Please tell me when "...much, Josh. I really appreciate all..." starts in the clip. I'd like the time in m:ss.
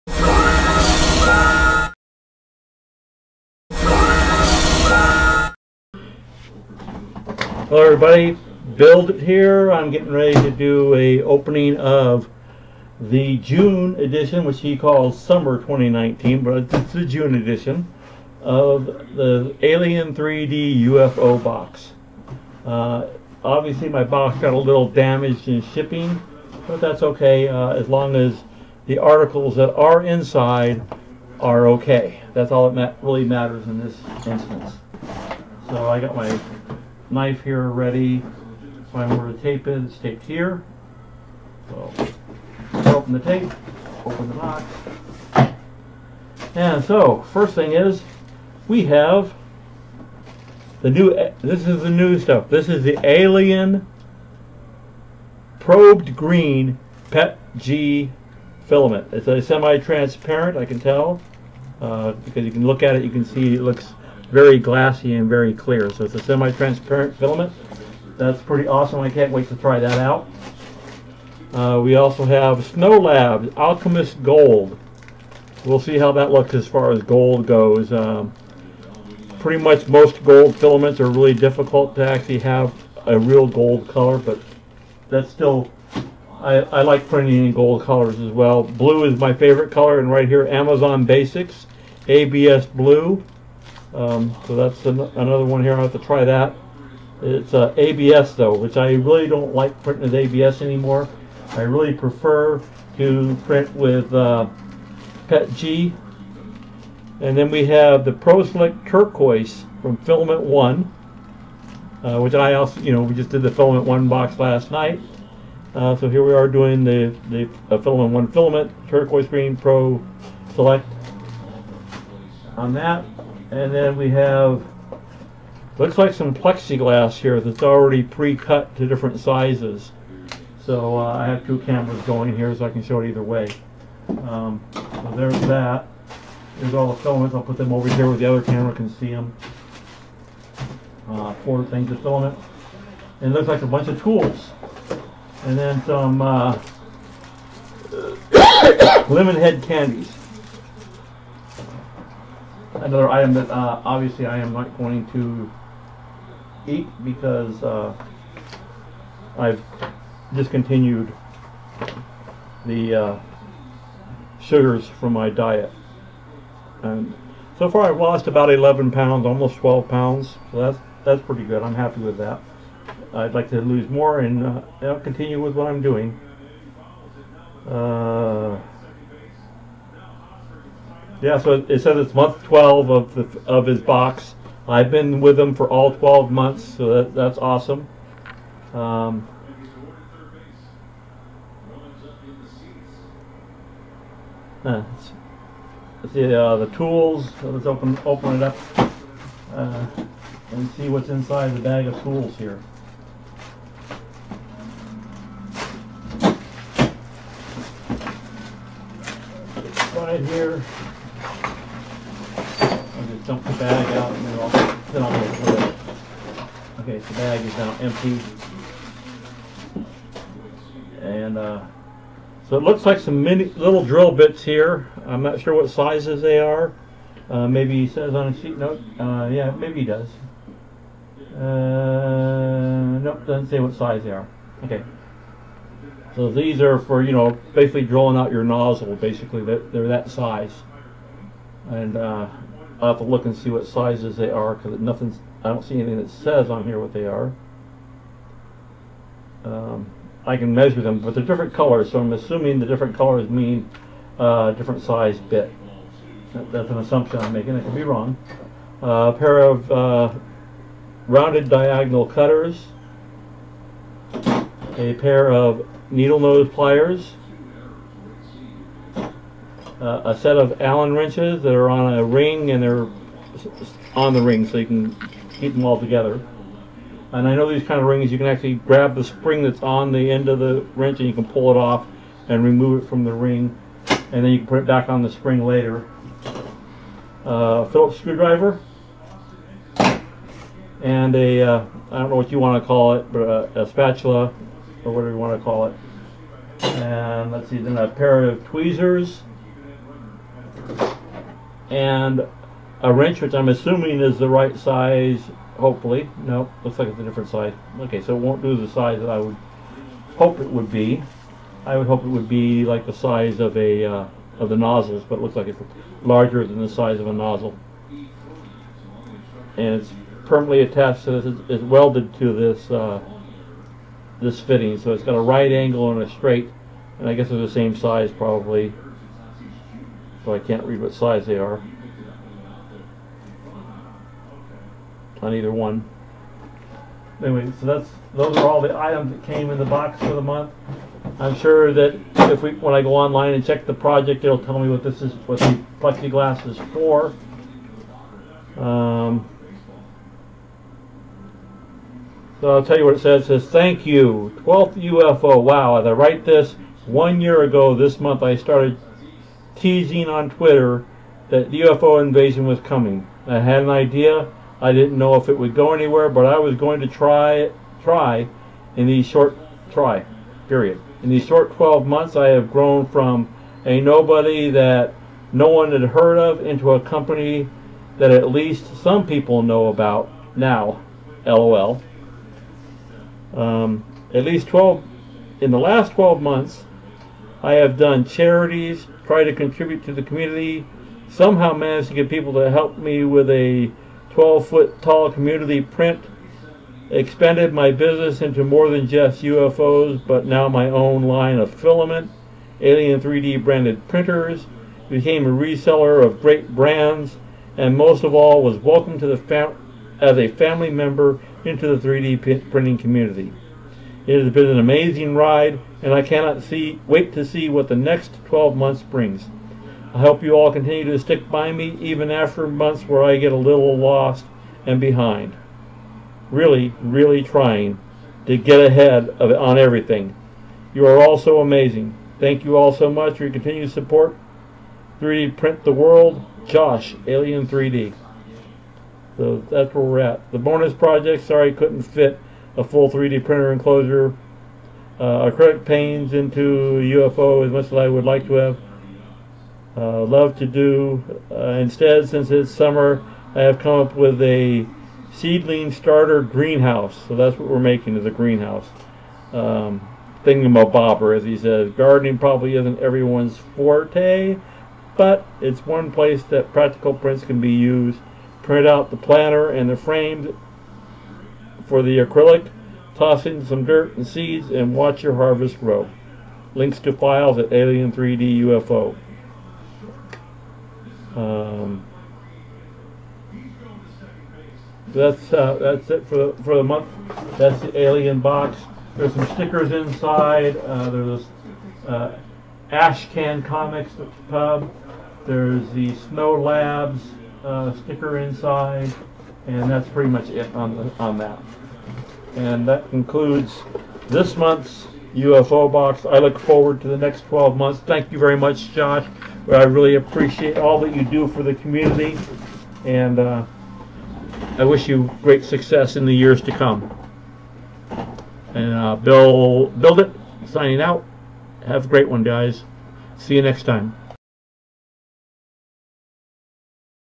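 8:28.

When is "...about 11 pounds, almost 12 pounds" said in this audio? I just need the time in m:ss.
2:48.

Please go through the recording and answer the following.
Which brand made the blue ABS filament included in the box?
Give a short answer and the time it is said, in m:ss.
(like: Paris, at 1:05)
Amazon Basics, at 1:30.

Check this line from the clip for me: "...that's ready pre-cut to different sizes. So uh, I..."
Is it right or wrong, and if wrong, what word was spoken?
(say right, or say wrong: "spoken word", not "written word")
wrong: "already", not "ready".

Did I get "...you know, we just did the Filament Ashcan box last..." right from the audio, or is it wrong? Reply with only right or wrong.
wrong.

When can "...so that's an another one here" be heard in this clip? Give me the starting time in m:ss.
1:34.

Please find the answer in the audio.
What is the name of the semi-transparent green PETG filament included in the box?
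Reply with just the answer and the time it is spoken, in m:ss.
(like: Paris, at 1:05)
Alien Probed Green, at 0:53.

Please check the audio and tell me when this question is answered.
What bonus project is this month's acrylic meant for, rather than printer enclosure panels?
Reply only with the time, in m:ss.
7:35.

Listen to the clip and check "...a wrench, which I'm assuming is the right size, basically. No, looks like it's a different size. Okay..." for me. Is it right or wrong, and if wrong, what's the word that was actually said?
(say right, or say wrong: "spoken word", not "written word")
wrong: "hopefully", not "basically".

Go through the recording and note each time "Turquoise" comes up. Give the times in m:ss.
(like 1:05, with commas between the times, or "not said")
1:48, 1:58.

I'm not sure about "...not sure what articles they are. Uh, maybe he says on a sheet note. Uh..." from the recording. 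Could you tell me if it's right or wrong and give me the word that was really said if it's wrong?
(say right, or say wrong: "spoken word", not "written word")
wrong: "sizes", not "articles".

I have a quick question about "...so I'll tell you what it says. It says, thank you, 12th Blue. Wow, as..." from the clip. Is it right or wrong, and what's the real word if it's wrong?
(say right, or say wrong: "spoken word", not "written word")
wrong: "UFO", not "Blue".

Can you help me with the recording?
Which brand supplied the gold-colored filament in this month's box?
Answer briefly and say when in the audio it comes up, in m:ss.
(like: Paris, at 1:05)
Snow Lab, at 1:12.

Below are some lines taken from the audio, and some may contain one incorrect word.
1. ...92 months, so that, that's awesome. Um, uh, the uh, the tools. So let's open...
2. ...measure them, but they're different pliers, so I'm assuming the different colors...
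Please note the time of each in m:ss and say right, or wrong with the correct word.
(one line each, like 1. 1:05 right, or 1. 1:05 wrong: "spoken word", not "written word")
1. 3:05 wrong: "12", not "92"
2. 4:10 wrong: "colors", not "pliers".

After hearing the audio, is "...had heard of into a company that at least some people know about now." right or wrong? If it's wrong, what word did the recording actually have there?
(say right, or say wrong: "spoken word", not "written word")
right.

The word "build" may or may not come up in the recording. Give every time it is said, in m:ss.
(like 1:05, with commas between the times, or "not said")
0:08, 8:39.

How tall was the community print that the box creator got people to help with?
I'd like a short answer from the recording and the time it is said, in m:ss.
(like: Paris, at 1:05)
12 foot, at 6:34.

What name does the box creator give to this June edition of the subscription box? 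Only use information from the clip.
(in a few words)
Summer 2019.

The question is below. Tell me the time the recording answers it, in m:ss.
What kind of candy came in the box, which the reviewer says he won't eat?
2:29.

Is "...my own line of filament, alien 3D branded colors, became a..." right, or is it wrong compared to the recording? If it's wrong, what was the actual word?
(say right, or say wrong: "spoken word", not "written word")
wrong: "printers", not "colors".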